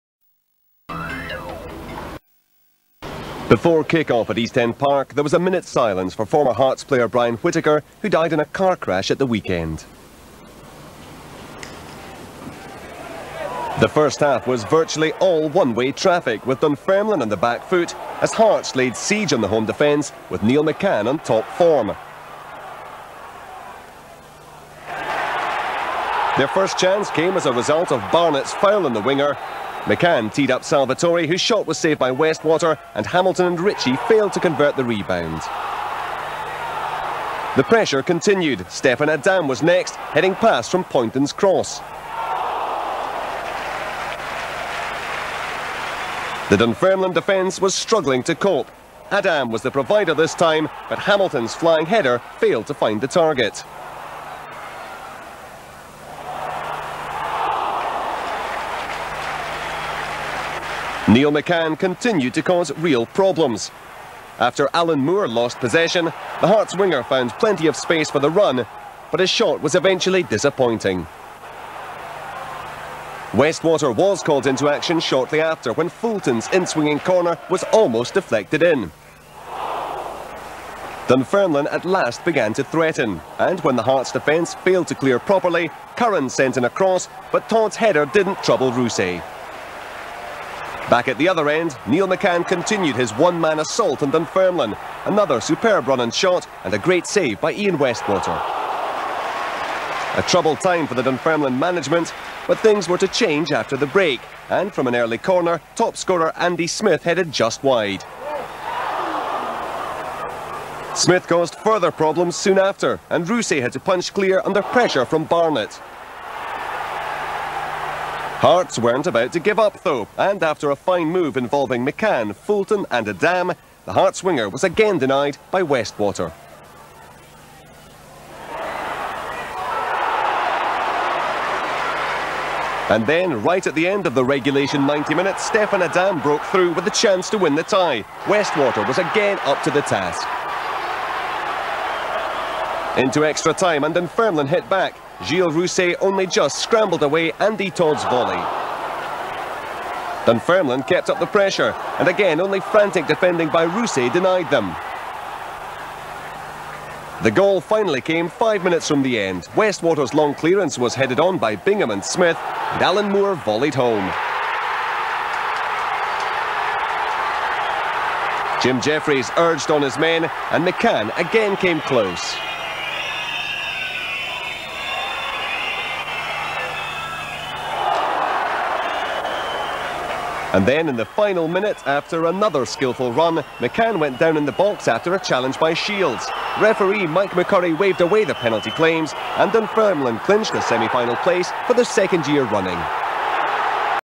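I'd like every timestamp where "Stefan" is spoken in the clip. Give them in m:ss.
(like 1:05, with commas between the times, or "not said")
0:38, 2:15.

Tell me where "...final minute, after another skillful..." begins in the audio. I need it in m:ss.
3:01.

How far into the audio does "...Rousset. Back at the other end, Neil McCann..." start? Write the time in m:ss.
1:28.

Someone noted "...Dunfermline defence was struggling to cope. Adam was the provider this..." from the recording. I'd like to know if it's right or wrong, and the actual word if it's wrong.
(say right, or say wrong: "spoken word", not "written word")
right.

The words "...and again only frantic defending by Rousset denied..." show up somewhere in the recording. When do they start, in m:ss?
2:31.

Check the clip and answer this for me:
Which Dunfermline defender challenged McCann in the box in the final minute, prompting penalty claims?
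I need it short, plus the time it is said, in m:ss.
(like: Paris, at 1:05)
Shields, at 3:05.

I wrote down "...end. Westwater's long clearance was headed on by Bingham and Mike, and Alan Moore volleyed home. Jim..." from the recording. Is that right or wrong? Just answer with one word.
wrong.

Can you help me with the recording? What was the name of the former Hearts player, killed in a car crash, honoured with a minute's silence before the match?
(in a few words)
Brian Whitaker.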